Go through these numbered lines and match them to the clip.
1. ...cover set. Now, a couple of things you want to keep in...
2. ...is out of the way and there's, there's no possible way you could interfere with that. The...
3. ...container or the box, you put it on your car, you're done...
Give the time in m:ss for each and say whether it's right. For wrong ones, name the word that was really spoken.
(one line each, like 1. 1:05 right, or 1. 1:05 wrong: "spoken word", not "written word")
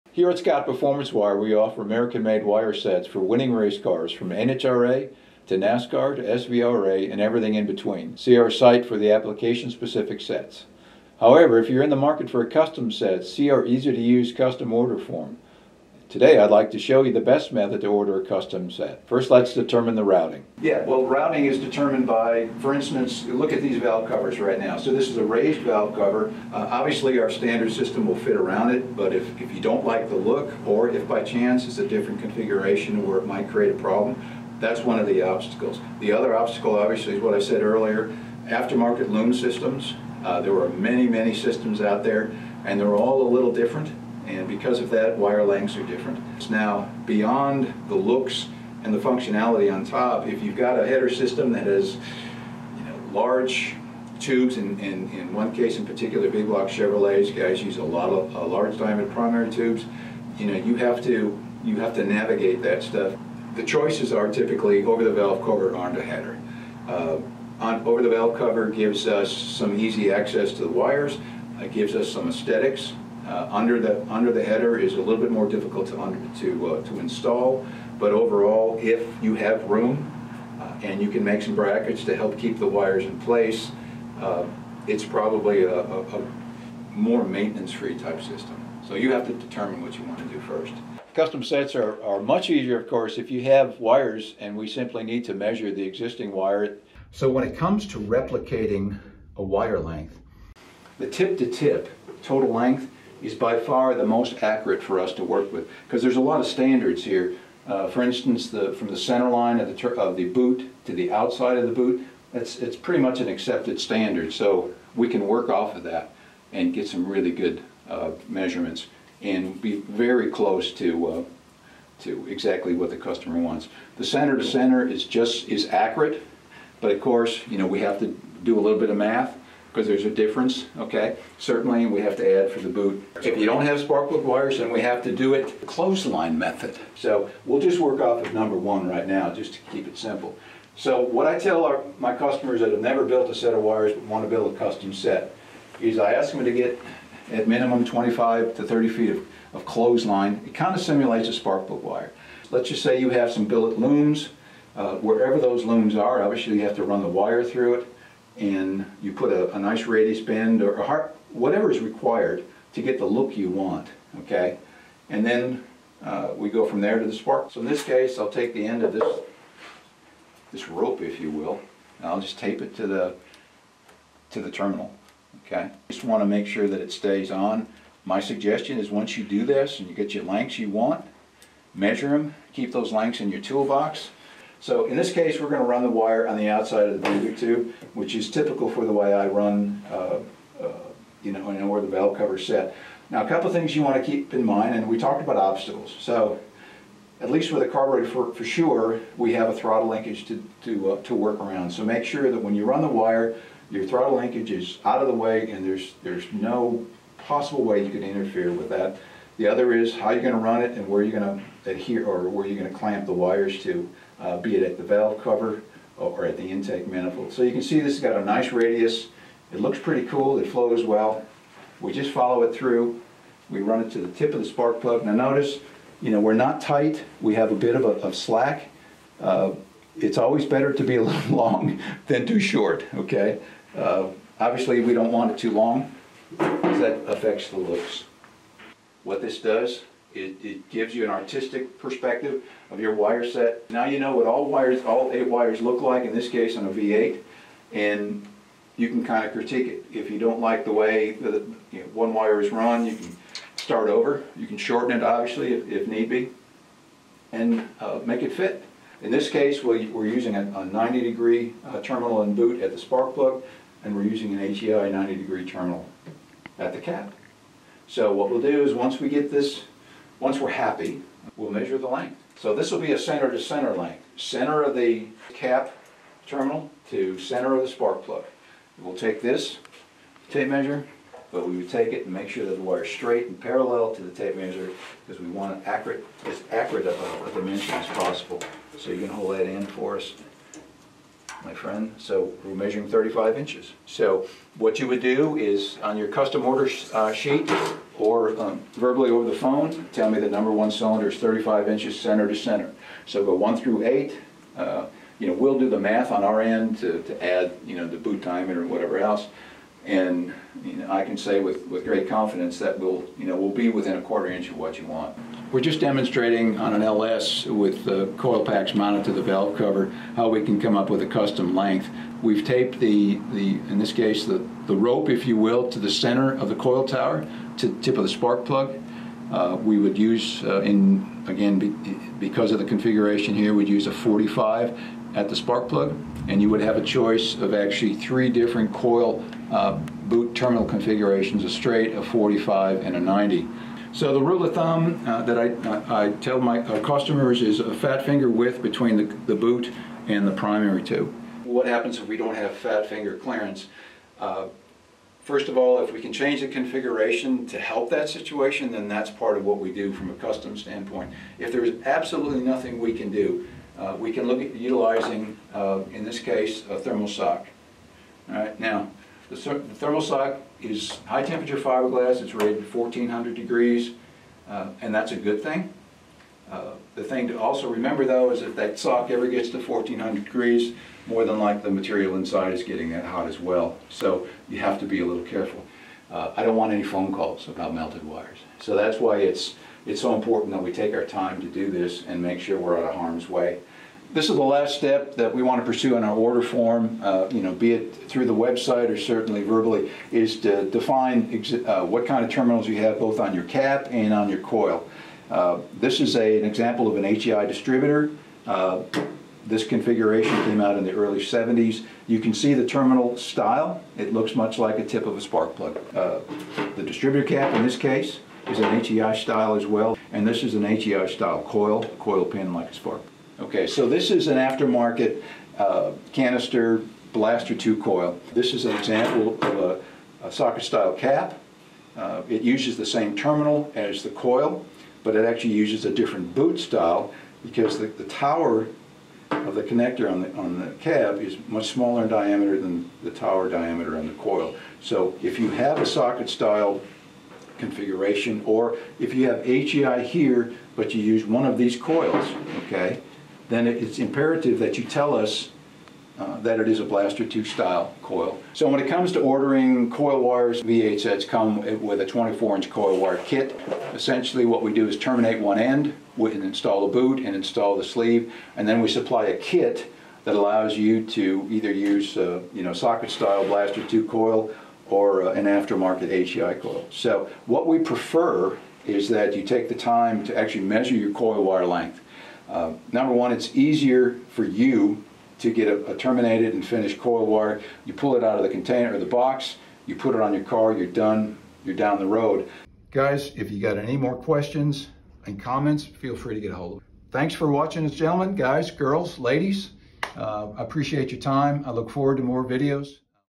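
1. 3:12 right
2. 3:24 right
3. 8:08 right.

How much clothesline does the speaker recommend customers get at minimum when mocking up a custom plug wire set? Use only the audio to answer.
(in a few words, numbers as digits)
25 to 30 feet.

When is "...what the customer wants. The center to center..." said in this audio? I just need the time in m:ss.
2:02.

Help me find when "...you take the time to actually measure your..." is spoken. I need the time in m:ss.
7:59.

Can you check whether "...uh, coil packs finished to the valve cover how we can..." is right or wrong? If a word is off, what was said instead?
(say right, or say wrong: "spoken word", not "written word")
wrong: "mounted", not "finished".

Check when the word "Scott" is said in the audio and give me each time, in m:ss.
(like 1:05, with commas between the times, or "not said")
0:00.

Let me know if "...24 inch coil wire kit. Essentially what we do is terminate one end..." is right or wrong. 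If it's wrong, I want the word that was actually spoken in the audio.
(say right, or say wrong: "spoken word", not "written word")
right.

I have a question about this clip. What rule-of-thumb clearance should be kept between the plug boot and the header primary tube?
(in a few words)
a fat finger width.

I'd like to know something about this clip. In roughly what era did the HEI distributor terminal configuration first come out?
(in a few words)
early 70s.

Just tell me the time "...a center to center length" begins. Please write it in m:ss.
4:32.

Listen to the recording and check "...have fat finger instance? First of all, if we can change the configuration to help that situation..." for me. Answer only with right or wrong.
wrong.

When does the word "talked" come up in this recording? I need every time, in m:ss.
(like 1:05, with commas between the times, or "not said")
3:14.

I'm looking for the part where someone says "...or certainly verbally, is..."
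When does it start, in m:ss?
6:38.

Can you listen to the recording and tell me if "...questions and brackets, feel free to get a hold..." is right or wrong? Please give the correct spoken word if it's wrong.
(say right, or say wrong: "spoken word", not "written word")
wrong: "comments", not "brackets".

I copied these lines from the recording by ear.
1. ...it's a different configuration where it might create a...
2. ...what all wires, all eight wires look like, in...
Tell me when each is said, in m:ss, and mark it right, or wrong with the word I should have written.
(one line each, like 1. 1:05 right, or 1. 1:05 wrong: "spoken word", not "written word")
1. 0:31 right
2. 4:04 right.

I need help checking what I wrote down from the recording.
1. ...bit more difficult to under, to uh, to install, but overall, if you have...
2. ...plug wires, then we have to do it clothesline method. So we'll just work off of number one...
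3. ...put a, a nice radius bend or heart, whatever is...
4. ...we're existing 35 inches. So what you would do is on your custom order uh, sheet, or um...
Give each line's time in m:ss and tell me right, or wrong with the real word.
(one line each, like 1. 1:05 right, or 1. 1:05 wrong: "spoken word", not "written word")
1. 1:15 right
2. 2:14 right
3. 2:39 right
4. 4:52 wrong: "measuring", not "existing".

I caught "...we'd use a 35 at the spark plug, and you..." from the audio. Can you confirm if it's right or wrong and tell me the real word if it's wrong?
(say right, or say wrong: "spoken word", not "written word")
wrong: "45", not "35".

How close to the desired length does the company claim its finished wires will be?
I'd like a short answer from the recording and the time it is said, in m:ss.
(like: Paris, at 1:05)
within a quarter inch, at 5:13.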